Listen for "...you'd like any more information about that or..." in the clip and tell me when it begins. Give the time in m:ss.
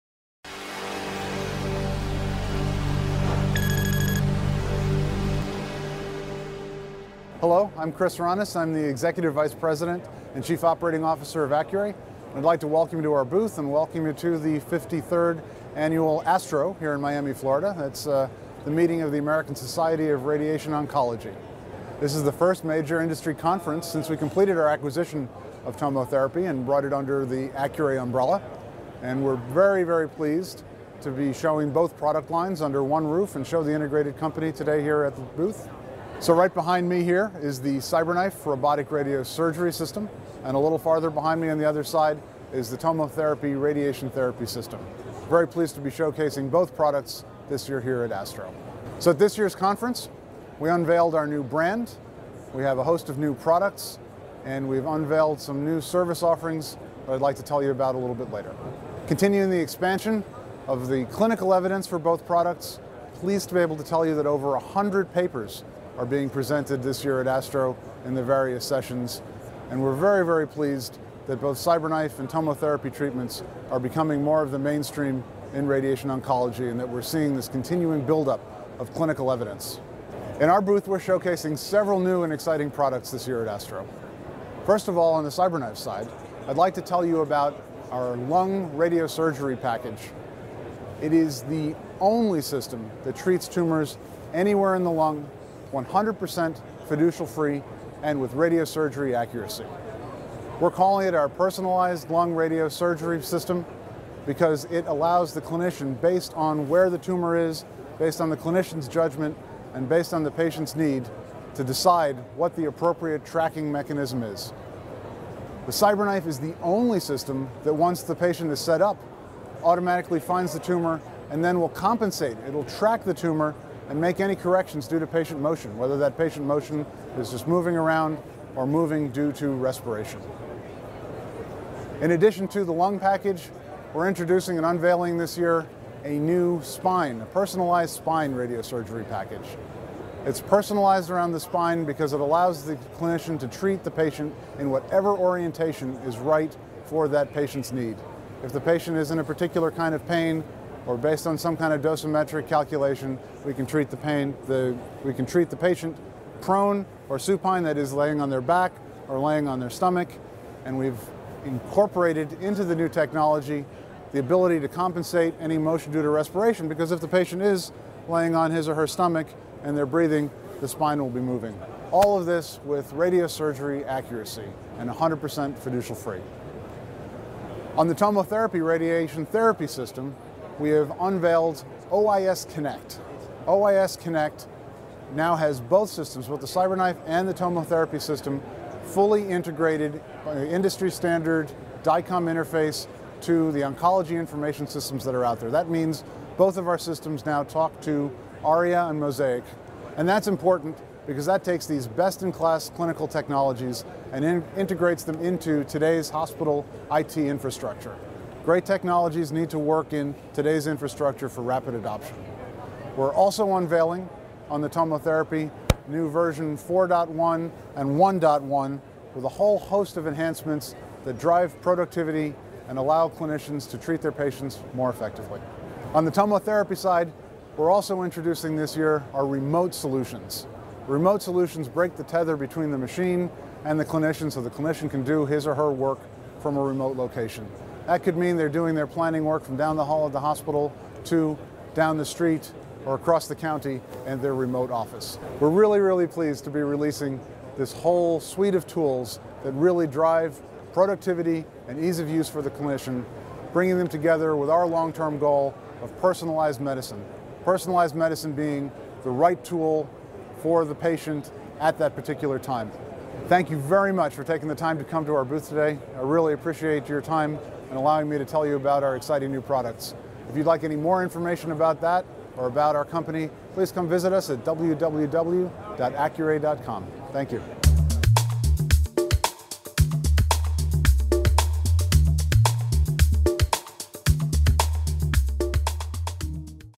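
4:30.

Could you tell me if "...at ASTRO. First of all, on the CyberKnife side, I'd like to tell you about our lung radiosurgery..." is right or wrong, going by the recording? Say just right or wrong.
right.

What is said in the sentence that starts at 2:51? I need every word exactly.
All of this with radiosurgery accuracy and 100% fiducial free.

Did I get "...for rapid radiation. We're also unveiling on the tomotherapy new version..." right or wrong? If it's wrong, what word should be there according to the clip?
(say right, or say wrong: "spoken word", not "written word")
wrong: "adoption", not "radiation".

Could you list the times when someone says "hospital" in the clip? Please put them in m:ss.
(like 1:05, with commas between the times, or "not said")
3:26, 4:00.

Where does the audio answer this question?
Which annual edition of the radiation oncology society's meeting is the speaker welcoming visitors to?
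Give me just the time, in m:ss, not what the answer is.
0:14.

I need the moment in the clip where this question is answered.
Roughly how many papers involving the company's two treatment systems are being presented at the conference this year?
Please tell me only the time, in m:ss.
1:04.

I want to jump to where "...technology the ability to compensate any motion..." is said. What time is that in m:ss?
2:42.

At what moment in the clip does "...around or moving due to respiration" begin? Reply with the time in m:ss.
2:07.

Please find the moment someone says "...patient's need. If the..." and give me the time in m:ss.
2:27.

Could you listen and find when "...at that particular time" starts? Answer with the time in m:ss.
4:21.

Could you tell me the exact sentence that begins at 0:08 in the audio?
I'm the Executive Vice President and Chief Operating Officer of Accuray.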